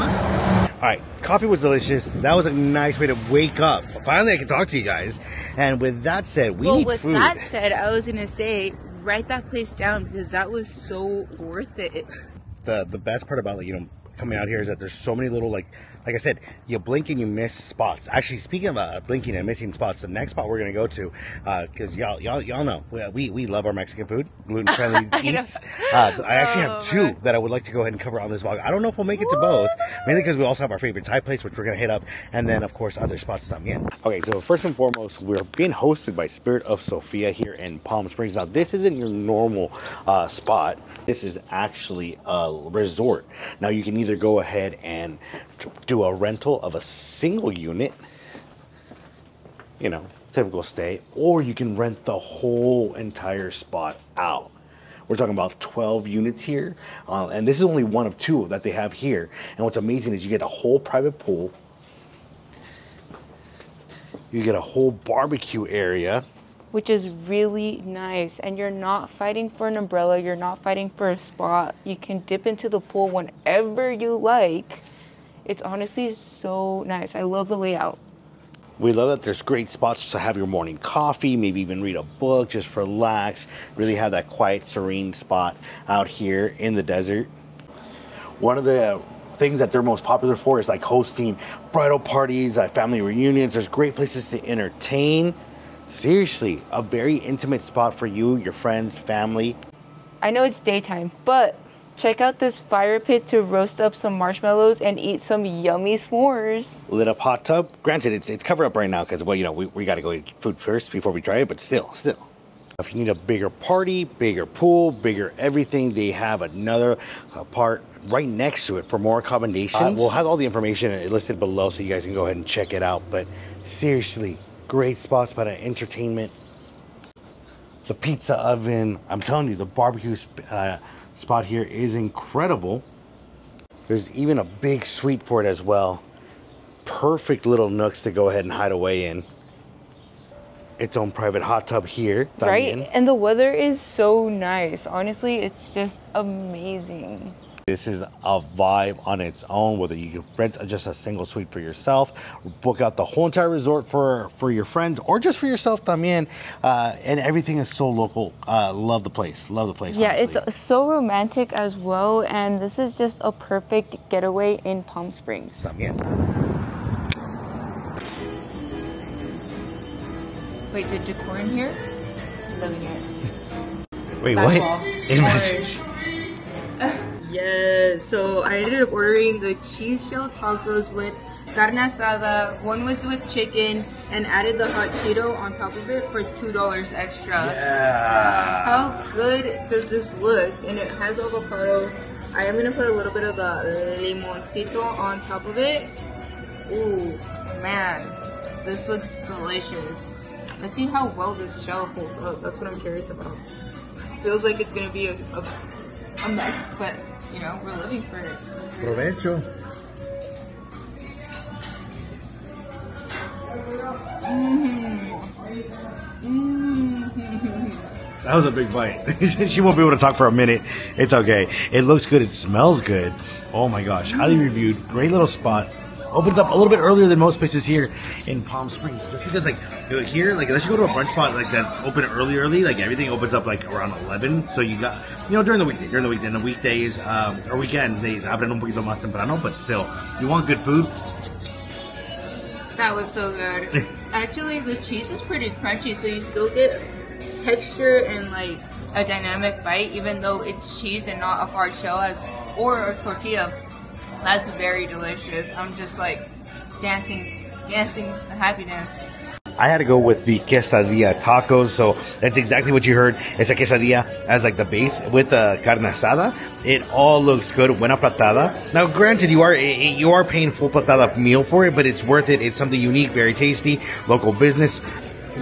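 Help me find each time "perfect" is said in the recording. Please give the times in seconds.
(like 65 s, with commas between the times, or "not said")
136 s, 163 s.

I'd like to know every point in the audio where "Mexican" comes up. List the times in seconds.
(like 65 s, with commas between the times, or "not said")
23 s.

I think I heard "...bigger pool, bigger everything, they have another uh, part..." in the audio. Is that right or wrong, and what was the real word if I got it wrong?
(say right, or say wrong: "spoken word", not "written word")
right.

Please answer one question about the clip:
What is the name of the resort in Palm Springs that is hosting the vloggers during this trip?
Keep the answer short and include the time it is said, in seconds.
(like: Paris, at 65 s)
Spirit of Sophia, at 36 s.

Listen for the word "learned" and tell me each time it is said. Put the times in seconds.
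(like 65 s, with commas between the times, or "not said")
not said.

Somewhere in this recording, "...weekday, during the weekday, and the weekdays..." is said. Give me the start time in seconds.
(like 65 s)
235 s.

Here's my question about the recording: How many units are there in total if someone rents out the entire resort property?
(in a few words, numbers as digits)
12.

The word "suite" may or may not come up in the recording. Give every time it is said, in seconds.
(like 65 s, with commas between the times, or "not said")
134 s, 151 s.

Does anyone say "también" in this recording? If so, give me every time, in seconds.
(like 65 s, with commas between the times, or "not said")
155 s, 165 s.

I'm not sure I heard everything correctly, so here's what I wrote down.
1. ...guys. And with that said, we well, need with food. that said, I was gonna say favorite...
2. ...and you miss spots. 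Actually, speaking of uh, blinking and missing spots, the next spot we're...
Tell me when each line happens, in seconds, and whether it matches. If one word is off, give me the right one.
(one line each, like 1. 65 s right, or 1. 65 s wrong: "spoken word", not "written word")
1. 4 s wrong: "write", not "favorite"
2. 17 s right.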